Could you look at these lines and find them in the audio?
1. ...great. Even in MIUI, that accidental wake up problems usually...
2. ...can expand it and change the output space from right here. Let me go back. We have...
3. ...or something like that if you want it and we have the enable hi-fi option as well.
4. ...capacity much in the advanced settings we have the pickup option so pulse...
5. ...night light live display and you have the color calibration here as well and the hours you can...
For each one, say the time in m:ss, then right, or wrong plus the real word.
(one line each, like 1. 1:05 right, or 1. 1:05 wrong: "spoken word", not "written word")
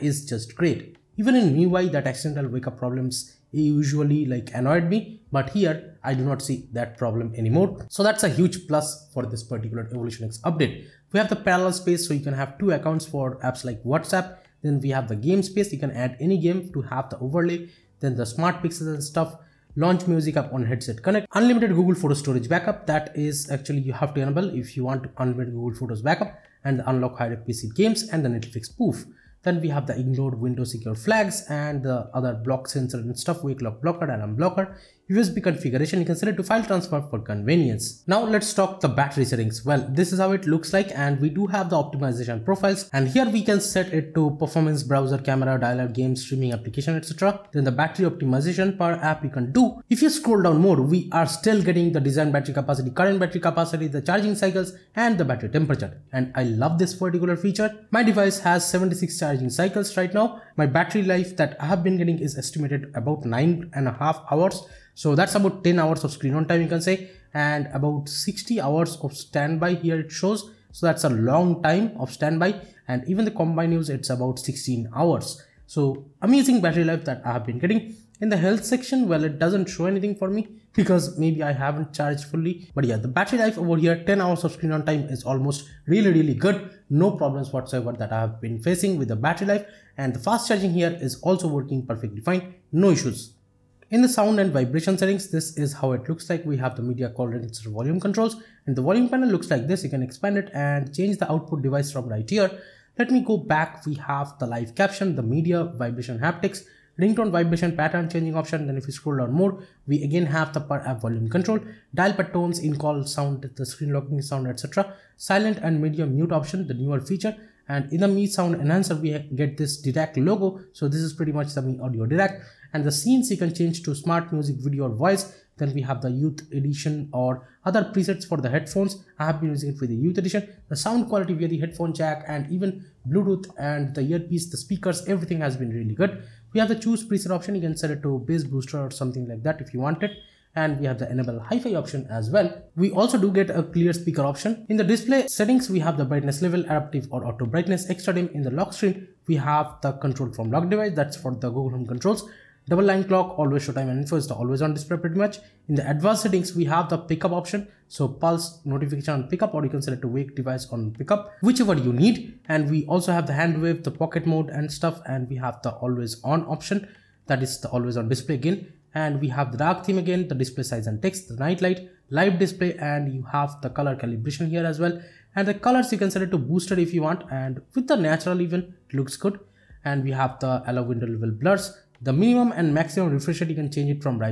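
1. 0:00 right
2. 1:39 wrong: "device", not "space"
3. 2:18 right
4. 2:34 wrong: "pretty", not "capacity"
5. 2:51 wrong: "colors", not "hours".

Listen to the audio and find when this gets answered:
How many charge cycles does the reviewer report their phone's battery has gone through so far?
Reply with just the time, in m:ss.
0:58.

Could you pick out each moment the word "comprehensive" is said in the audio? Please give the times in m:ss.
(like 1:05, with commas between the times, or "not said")
not said.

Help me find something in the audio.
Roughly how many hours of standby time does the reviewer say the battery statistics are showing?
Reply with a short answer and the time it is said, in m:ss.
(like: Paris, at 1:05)
60 hours, at 1:08.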